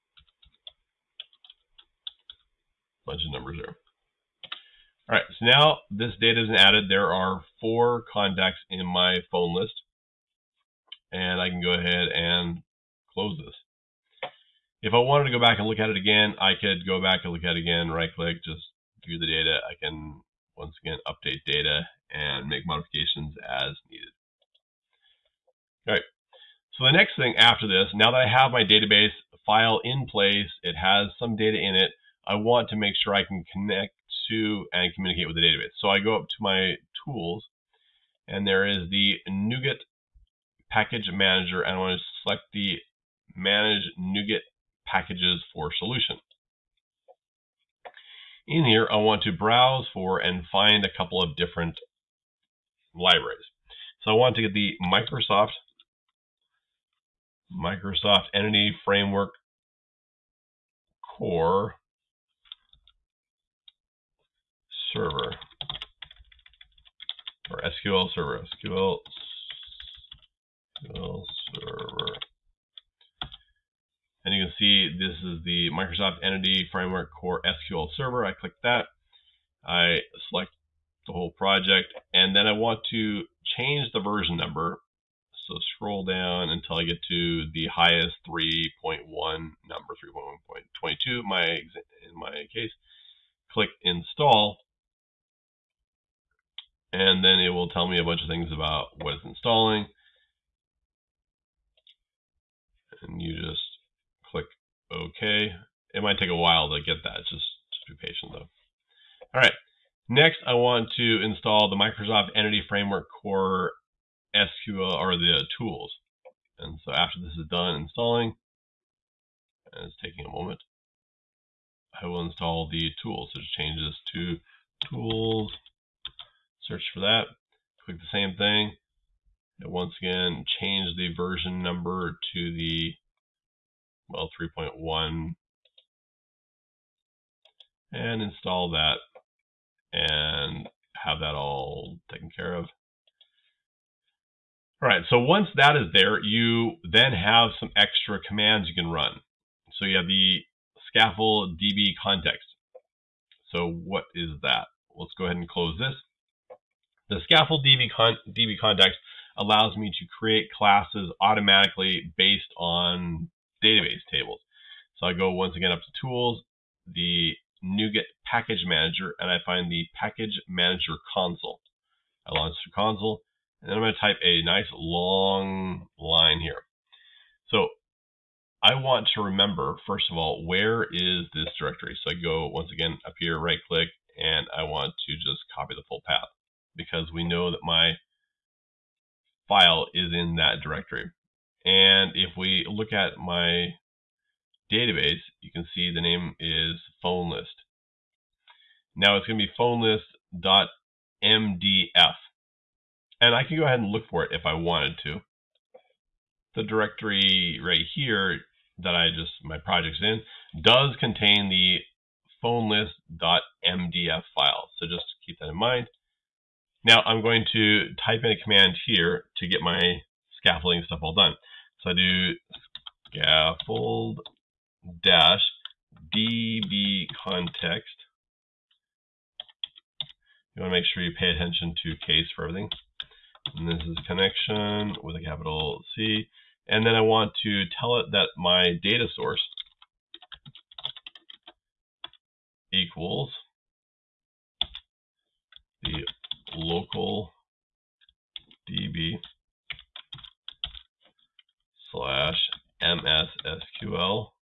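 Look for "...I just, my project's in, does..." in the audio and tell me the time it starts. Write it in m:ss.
3:28.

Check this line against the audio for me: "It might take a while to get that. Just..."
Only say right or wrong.
right.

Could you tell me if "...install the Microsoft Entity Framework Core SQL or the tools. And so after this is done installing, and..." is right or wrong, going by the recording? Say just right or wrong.
right.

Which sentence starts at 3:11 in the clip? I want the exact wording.
And if we look at my database, you can see the name is phone list.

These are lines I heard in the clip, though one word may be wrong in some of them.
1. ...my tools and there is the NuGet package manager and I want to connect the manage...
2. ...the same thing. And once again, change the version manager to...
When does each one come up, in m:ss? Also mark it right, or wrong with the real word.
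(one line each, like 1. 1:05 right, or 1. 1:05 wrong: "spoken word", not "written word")
1. 0:36 wrong: "select", not "connect"
2. 2:07 wrong: "number", not "manager".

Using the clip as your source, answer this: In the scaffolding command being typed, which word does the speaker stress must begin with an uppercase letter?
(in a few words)
Connection.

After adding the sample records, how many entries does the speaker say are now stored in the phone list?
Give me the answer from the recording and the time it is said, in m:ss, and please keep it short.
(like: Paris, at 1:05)
4, at 0:07.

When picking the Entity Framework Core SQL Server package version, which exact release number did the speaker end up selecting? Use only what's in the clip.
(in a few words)
3.1.22.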